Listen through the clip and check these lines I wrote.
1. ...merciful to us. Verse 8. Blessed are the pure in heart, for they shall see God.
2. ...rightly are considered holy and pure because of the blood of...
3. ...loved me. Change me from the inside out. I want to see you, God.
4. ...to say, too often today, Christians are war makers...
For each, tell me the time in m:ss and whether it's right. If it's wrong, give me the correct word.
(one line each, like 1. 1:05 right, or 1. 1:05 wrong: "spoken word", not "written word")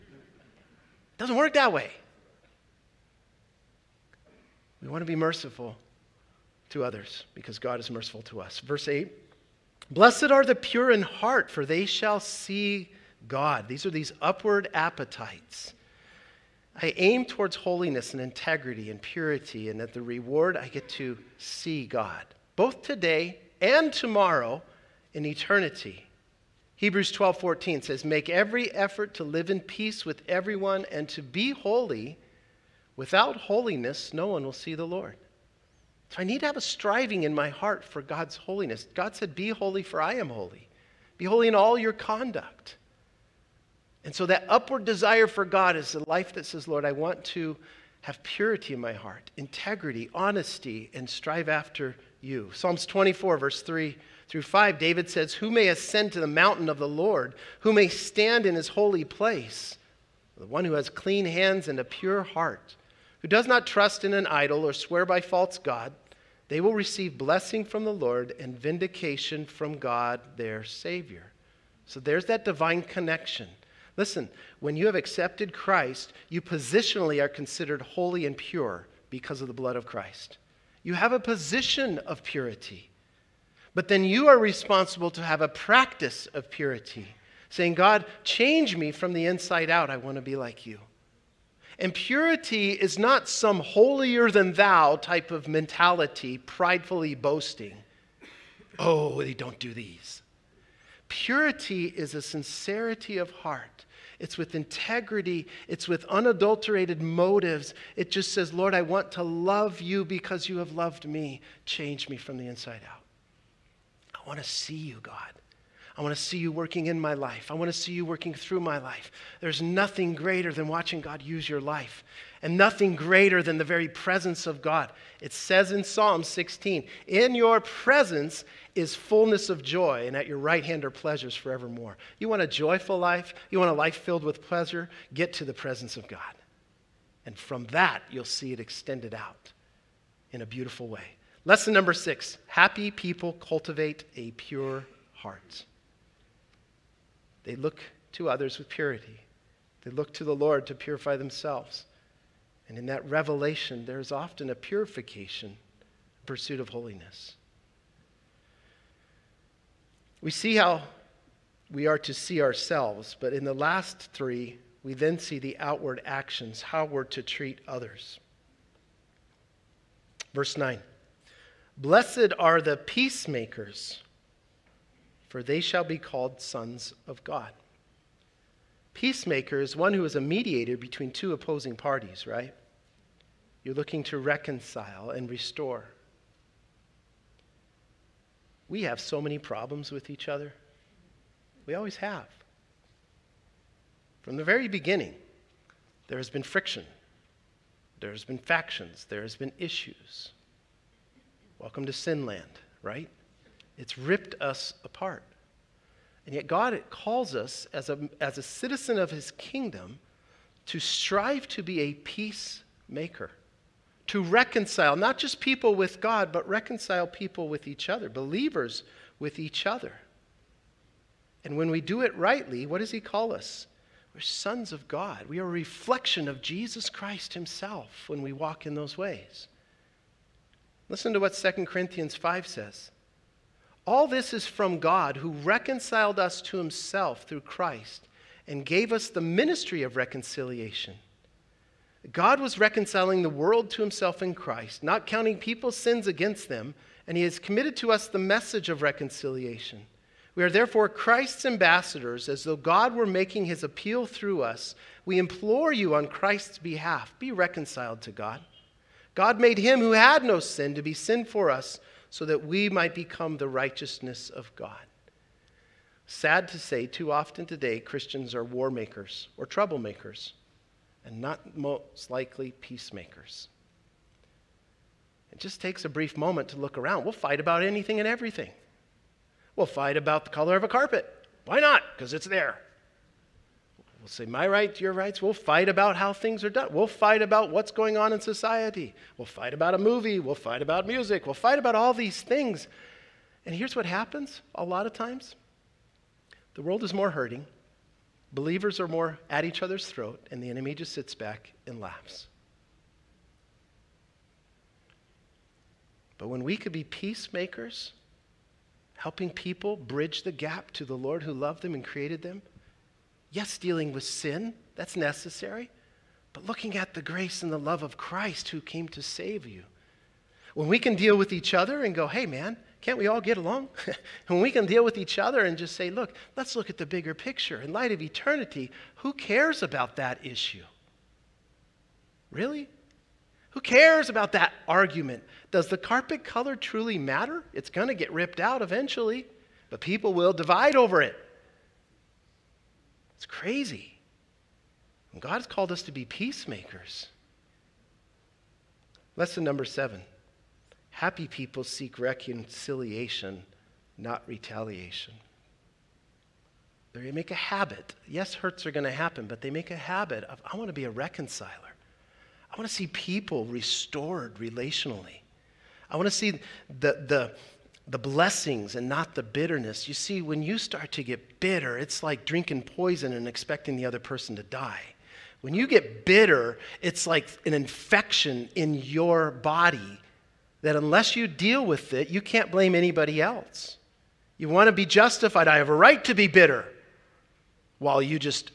1. 0:07 right
2. 1:16 wrong: "positionally", not "rightly"
3. 1:50 right
4. 4:26 right.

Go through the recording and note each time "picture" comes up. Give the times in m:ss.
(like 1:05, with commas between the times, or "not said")
5:27.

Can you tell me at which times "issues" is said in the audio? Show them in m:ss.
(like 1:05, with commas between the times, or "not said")
3:19, 5:30.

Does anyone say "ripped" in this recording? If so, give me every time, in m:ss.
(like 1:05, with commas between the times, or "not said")
3:23, 5:38.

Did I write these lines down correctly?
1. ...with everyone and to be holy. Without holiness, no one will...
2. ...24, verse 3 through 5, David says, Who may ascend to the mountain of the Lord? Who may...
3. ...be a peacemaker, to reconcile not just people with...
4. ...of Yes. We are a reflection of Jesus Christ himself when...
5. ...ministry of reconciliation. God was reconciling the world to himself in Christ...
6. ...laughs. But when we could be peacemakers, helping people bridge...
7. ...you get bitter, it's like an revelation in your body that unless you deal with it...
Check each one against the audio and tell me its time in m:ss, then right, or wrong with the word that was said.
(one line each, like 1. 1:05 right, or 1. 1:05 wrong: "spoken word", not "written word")
1. 0:30 right
2. 0:52 right
3. 3:31 right
4. 3:44 wrong: "God", not "Yes"
5. 3:59 right
6. 5:01 right
7. 6:15 wrong: "infection", not "revelation".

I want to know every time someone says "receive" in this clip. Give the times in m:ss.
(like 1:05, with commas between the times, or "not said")
1:06.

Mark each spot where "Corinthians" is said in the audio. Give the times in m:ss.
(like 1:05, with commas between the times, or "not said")
3:51.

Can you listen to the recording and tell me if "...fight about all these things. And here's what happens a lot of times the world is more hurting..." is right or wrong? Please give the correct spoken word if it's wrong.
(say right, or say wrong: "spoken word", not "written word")
right.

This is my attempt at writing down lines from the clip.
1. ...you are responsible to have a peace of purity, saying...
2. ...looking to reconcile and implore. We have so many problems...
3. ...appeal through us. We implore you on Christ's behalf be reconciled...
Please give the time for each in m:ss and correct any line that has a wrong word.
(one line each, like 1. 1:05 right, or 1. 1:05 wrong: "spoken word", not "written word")
1. 1:24 wrong: "practice", not "peace"
2. 3:03 wrong: "restore", not "implore"
3. 4:13 right.